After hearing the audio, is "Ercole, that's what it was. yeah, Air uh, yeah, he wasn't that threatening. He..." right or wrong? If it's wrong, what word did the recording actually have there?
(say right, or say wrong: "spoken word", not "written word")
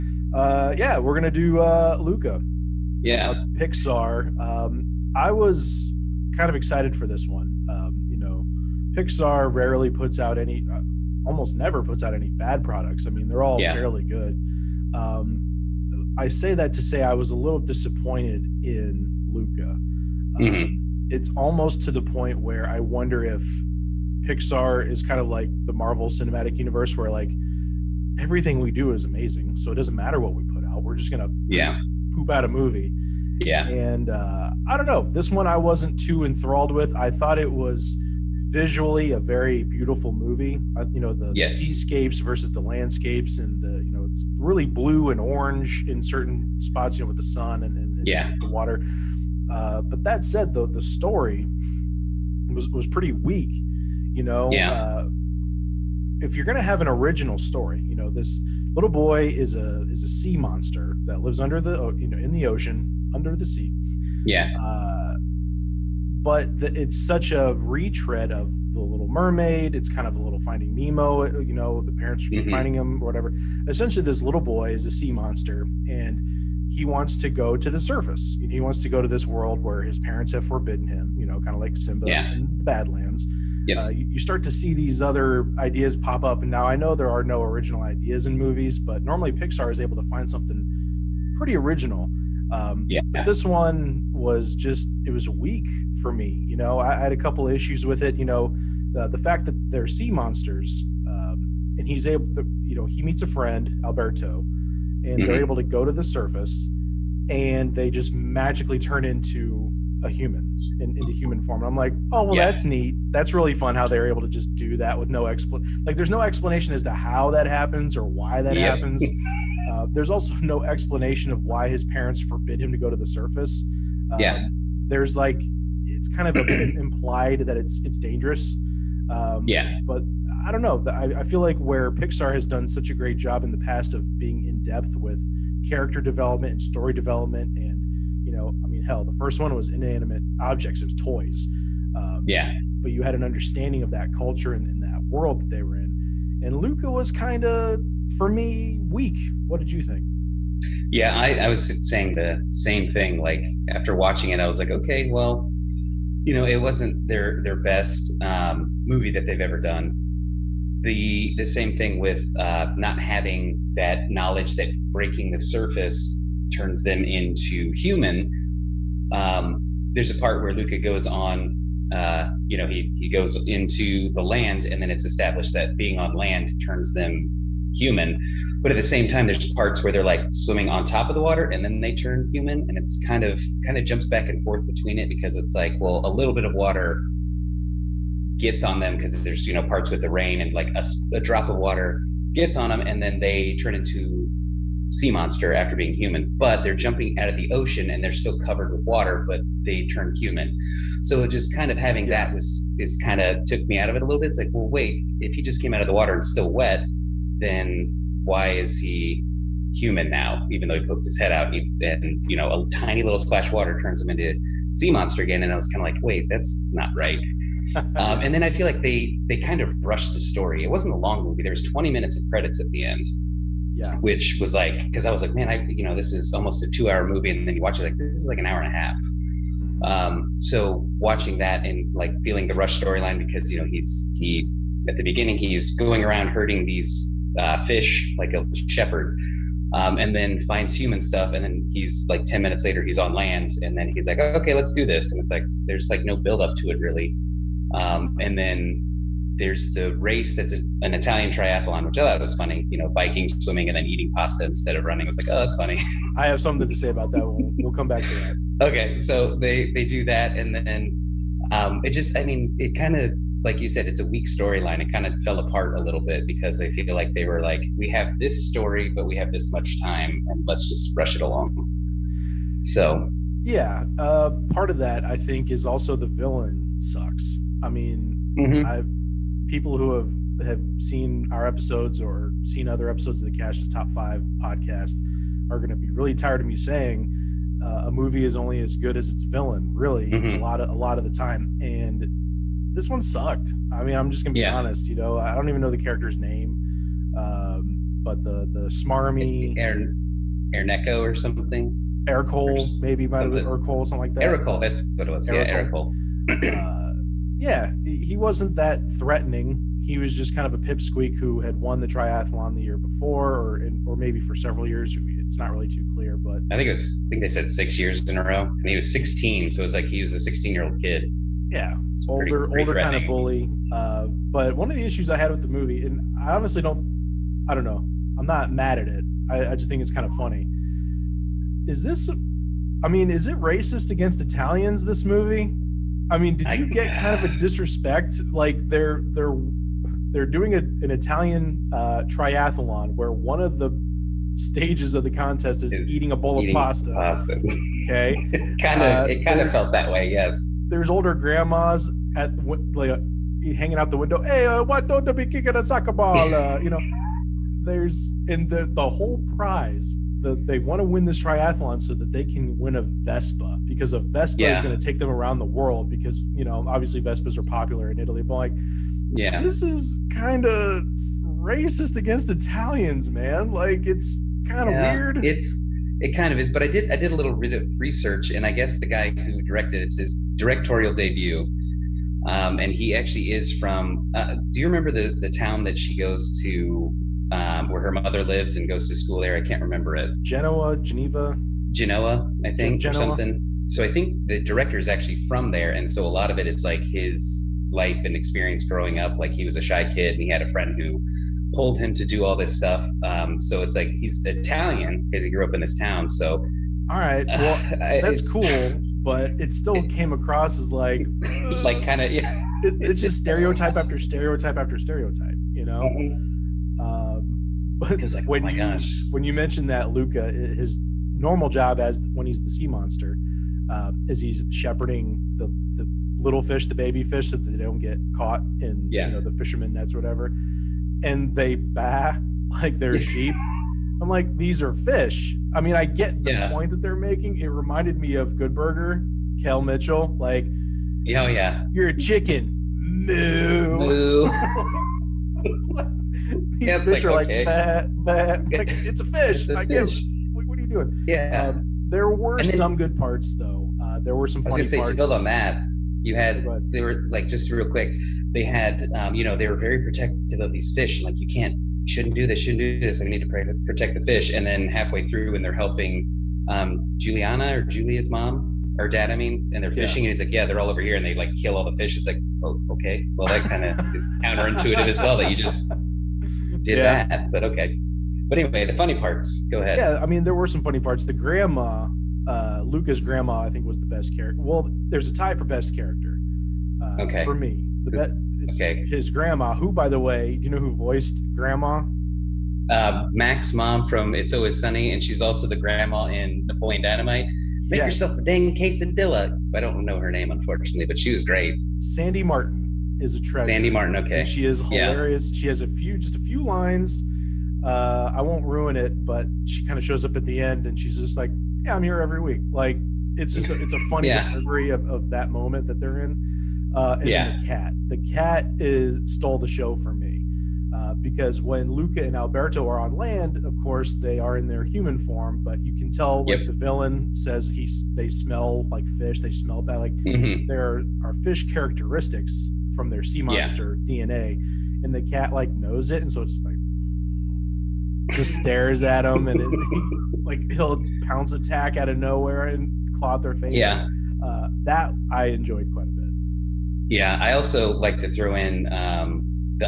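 right.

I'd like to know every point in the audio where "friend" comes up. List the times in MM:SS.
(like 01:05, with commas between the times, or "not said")
01:43, 06:40.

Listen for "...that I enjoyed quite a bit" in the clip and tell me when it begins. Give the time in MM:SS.
09:04.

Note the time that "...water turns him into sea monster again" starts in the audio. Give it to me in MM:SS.
03:33.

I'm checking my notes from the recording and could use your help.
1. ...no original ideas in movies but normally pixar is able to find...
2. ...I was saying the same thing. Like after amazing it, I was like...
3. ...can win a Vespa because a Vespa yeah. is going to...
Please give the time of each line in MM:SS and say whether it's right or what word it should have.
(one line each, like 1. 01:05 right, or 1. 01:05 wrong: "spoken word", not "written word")
1. 01:27 right
2. 02:31 wrong: "watching", not "amazing"
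3. 06:02 right.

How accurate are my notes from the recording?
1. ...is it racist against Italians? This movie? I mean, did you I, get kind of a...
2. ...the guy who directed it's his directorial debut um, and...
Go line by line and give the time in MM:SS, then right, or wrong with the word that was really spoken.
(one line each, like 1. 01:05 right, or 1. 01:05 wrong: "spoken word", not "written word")
1. 05:33 right
2. 06:18 right.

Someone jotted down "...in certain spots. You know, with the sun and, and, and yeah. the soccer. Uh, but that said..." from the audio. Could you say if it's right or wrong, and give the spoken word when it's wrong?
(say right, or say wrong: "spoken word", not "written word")
wrong: "water", not "soccer".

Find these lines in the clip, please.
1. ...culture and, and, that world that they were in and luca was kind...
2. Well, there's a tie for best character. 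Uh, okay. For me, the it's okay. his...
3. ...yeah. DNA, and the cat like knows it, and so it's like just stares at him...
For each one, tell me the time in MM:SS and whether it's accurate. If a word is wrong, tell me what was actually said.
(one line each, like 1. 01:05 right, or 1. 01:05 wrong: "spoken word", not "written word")
1. 02:24 right
2. 08:04 right
3. 08:53 right.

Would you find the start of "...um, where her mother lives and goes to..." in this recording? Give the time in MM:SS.
06:27.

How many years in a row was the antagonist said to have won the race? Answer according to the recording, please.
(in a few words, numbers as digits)
6.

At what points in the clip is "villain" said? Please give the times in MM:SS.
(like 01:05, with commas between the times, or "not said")
04:36, 04:49, 08:46.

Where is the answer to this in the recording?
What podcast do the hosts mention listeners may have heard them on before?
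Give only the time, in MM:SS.
04:43.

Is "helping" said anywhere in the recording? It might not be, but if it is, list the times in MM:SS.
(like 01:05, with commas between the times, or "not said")
07:45.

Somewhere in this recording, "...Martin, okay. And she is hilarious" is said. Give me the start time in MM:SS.
08:23.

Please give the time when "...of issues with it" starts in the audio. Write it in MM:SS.
01:37.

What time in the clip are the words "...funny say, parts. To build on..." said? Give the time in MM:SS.
07:34.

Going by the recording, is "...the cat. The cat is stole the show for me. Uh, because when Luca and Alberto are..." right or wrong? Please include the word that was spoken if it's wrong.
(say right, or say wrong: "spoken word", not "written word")
right.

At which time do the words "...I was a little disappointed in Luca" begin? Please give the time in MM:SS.
00:17.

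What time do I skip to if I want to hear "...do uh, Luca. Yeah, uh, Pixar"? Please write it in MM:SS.
00:01.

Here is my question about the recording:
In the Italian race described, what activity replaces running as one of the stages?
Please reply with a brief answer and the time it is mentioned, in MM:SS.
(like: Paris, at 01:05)
Eating pasta, at 04:13.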